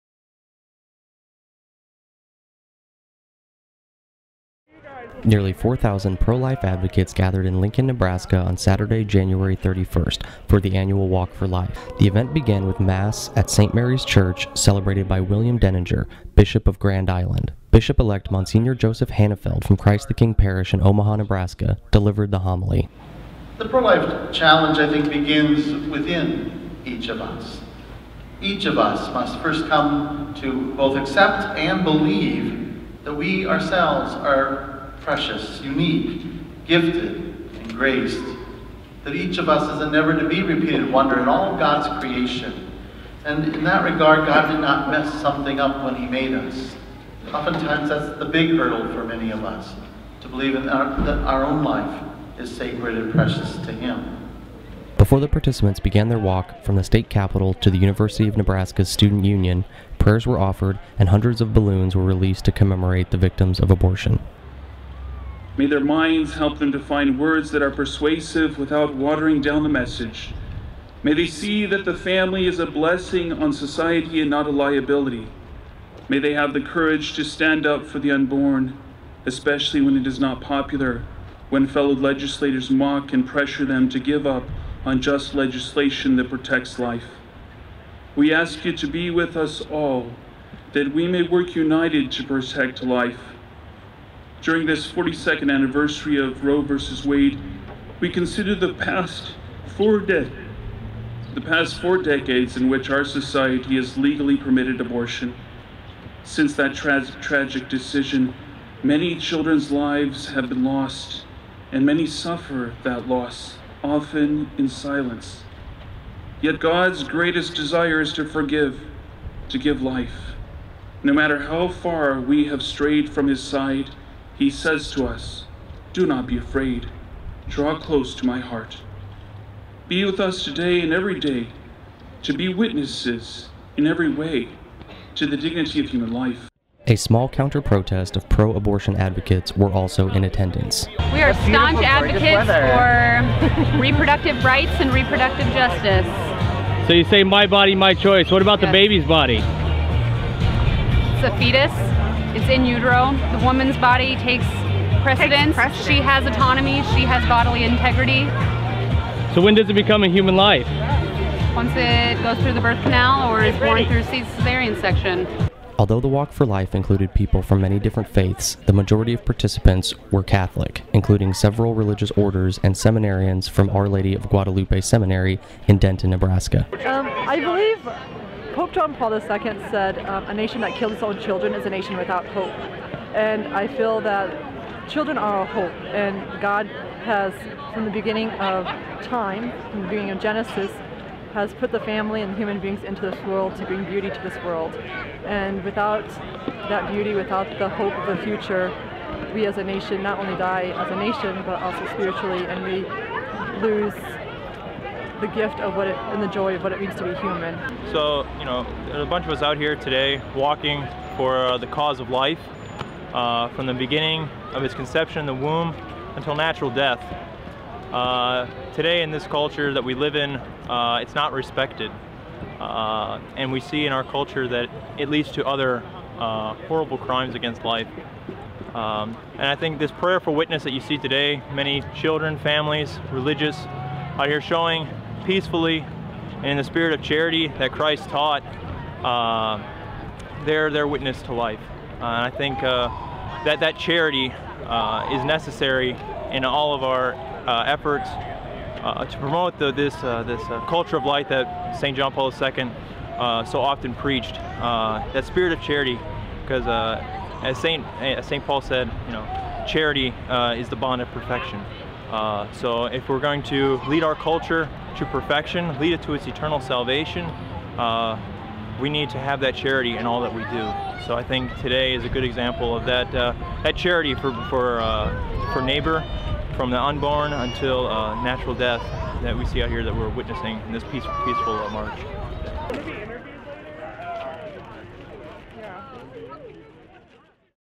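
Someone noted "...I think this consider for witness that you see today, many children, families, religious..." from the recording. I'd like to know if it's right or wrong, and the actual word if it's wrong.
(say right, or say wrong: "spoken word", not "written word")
wrong: "prayer", not "consider".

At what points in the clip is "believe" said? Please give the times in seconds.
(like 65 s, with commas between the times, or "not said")
31 s, 50 s, 177 s.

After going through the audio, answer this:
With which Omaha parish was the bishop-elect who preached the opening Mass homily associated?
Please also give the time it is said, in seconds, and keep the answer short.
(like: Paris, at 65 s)
Christ the King Parish, at 19 s.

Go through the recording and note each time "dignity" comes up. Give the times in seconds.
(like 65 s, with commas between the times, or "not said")
135 s.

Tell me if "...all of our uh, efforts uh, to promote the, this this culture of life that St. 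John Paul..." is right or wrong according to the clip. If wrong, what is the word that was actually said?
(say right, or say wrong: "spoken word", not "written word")
right.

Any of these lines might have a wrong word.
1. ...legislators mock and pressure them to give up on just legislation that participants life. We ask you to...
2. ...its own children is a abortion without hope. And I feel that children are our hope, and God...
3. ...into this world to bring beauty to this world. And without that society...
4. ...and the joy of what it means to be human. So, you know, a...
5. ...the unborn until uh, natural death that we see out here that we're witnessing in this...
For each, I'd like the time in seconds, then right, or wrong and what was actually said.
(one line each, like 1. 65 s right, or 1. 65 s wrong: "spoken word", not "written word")
1. 81 s wrong: "protects", not "participants"
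2. 180 s wrong: "nation", not "abortion"
3. 192 s wrong: "beauty", not "society"
4. 206 s right
5. 276 s right.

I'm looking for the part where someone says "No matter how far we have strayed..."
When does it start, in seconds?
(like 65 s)
121 s.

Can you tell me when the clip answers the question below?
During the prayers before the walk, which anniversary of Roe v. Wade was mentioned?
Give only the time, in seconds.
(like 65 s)
94 s.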